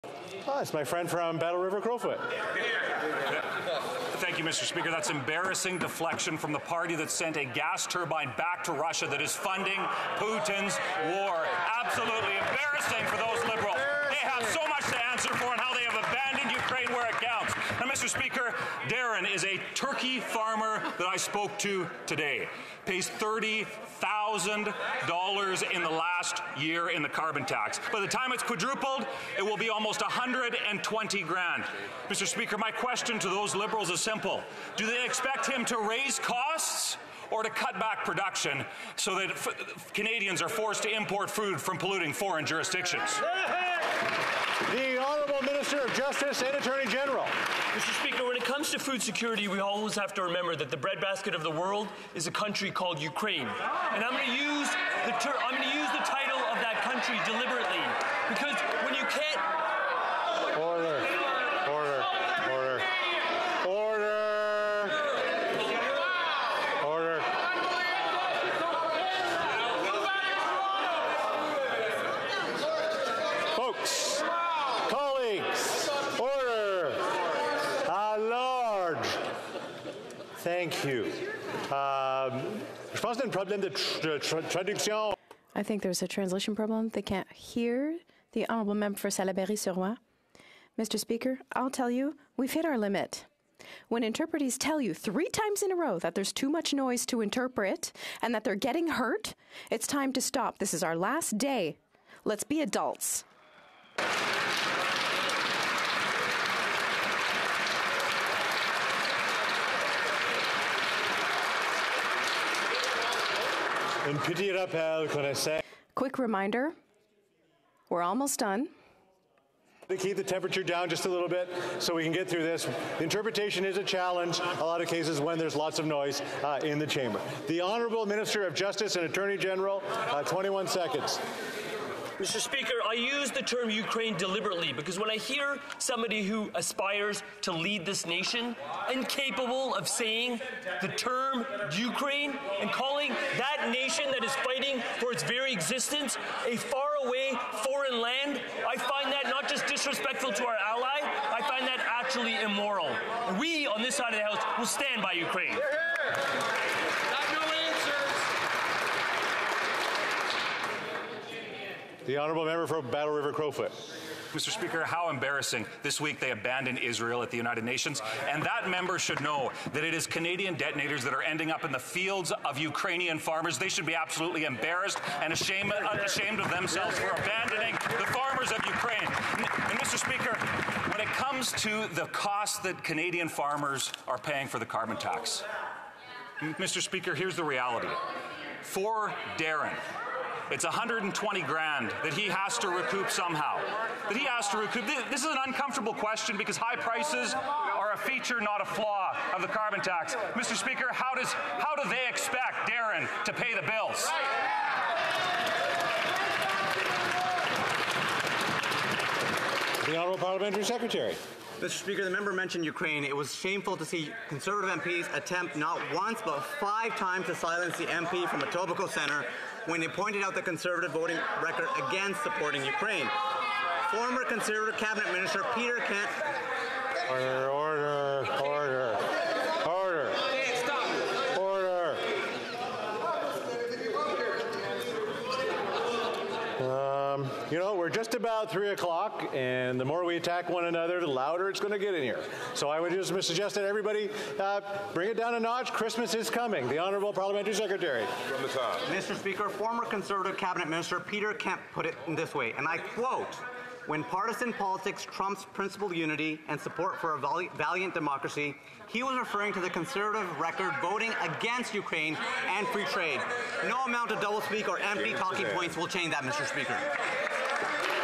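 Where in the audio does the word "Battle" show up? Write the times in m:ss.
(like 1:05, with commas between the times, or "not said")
0:01, 2:42.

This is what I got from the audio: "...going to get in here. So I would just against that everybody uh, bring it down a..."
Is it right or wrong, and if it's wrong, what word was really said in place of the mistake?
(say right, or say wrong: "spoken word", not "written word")
wrong: "suggest", not "against".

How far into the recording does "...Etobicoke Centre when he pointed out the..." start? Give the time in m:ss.
3:38.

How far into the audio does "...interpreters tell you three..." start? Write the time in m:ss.
1:34.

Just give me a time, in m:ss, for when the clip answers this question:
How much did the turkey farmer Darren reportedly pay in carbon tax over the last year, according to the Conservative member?
0:23.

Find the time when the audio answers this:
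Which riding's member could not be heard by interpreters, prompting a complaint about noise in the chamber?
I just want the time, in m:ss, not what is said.
1:29.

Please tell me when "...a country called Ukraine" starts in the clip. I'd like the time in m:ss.
0:52.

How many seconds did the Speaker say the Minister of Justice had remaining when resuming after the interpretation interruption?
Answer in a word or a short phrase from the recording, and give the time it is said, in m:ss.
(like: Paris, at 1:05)
21, at 2:10.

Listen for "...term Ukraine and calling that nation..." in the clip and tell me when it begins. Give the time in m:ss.
2:20.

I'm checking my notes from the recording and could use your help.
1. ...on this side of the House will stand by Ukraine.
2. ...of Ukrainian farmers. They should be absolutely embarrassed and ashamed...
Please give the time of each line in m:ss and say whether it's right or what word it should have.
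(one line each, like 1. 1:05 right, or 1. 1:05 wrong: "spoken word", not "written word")
1. 2:33 right
2. 2:52 right.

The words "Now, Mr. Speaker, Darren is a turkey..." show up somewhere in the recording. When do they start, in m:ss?
0:17.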